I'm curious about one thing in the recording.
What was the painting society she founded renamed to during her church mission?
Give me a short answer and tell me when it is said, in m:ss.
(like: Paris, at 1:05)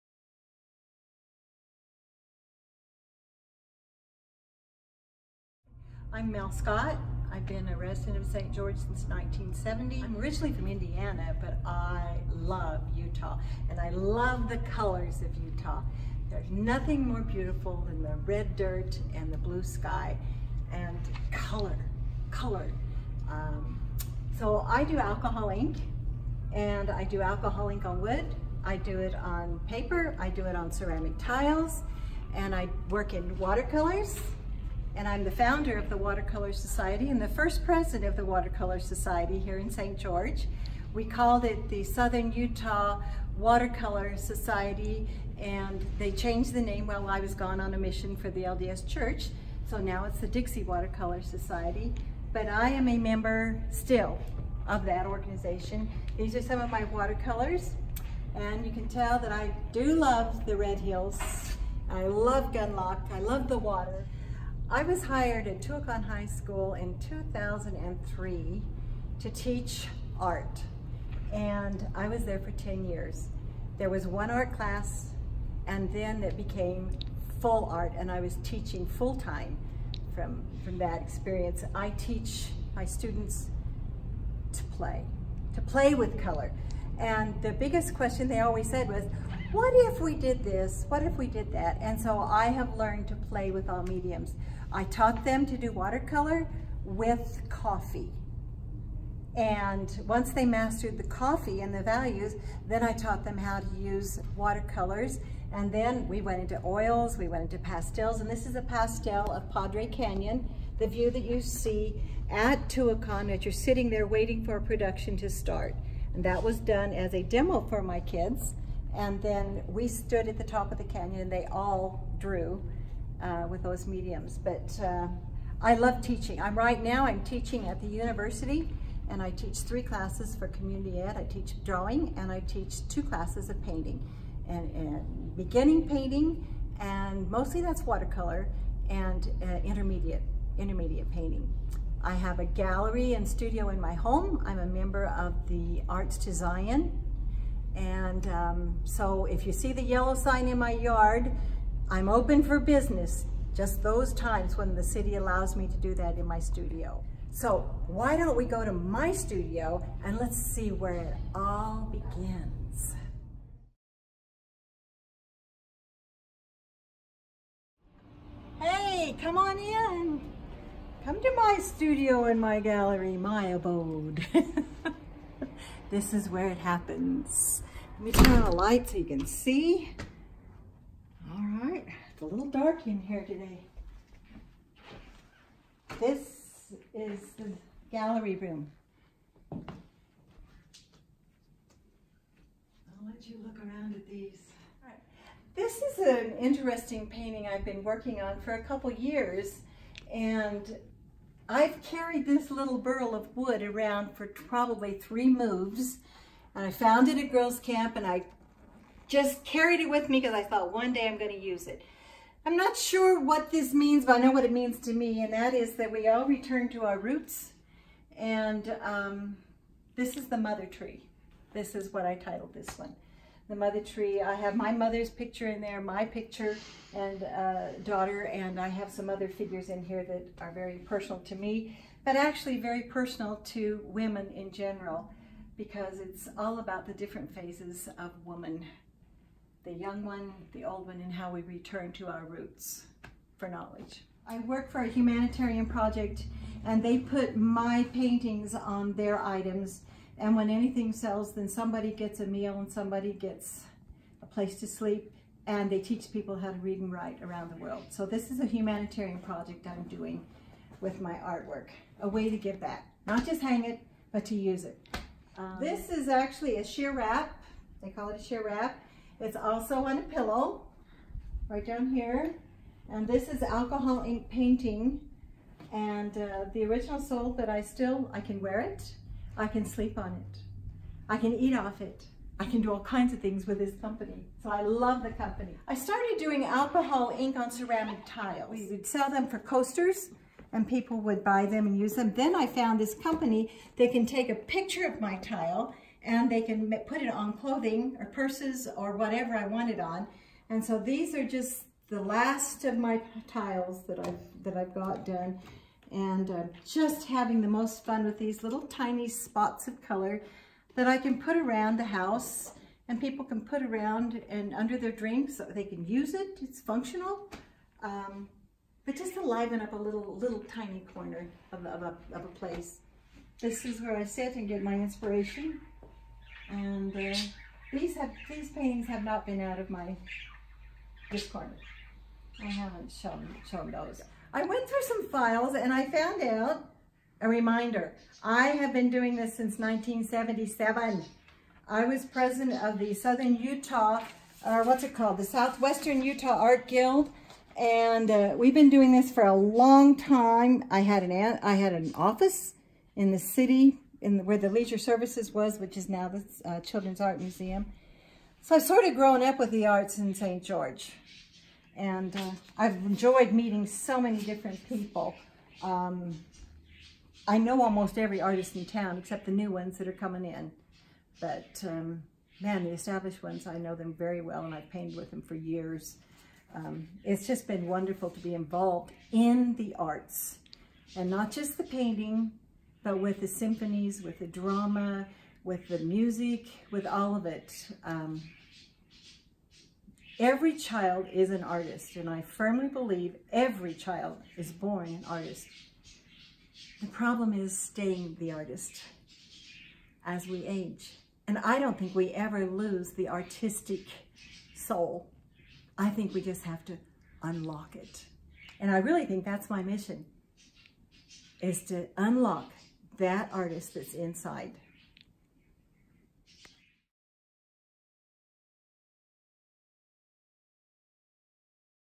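Dixie Watercolor Society, at 0:50.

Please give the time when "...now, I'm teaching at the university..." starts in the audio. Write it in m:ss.
2:06.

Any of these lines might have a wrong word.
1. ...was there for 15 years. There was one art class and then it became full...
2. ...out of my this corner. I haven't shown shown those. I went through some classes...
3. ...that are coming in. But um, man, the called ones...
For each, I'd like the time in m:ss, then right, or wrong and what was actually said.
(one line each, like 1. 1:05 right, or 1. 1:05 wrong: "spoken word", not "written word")
1. 1:12 wrong: "10", not "15"
2. 5:29 wrong: "files", not "classes"
3. 6:09 wrong: "established", not "called".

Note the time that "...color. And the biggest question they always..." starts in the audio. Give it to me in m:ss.
1:26.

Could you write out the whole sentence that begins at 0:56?
These are some of my watercolors and you can tell that I do love the Red Hills.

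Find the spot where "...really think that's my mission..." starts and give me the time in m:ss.
6:48.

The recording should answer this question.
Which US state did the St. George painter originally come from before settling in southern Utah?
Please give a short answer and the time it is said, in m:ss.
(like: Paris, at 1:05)
Indiana, at 0:10.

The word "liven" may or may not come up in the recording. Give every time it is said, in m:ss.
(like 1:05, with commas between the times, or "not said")
5:19.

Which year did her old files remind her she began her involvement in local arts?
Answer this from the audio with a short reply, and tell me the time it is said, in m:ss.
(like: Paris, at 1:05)
1977, at 5:39.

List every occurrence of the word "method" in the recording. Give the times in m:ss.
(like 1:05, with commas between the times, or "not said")
not said.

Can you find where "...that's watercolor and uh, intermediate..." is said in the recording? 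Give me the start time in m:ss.
2:17.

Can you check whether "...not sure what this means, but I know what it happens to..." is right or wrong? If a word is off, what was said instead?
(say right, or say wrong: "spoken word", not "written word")
wrong: "means", not "happens".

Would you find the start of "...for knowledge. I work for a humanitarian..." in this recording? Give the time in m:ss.
4:03.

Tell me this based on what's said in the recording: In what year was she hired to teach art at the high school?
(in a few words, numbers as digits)
2003.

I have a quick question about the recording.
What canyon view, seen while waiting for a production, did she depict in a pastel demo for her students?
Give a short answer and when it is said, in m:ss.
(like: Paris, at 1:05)
Padre Canyon, at 1:49.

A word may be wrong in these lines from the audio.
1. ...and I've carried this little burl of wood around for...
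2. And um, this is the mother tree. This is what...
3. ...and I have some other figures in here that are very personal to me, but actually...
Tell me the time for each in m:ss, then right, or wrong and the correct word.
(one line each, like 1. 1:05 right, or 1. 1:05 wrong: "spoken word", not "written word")
1. 3:20 right
2. 3:38 right
3. 3:48 right.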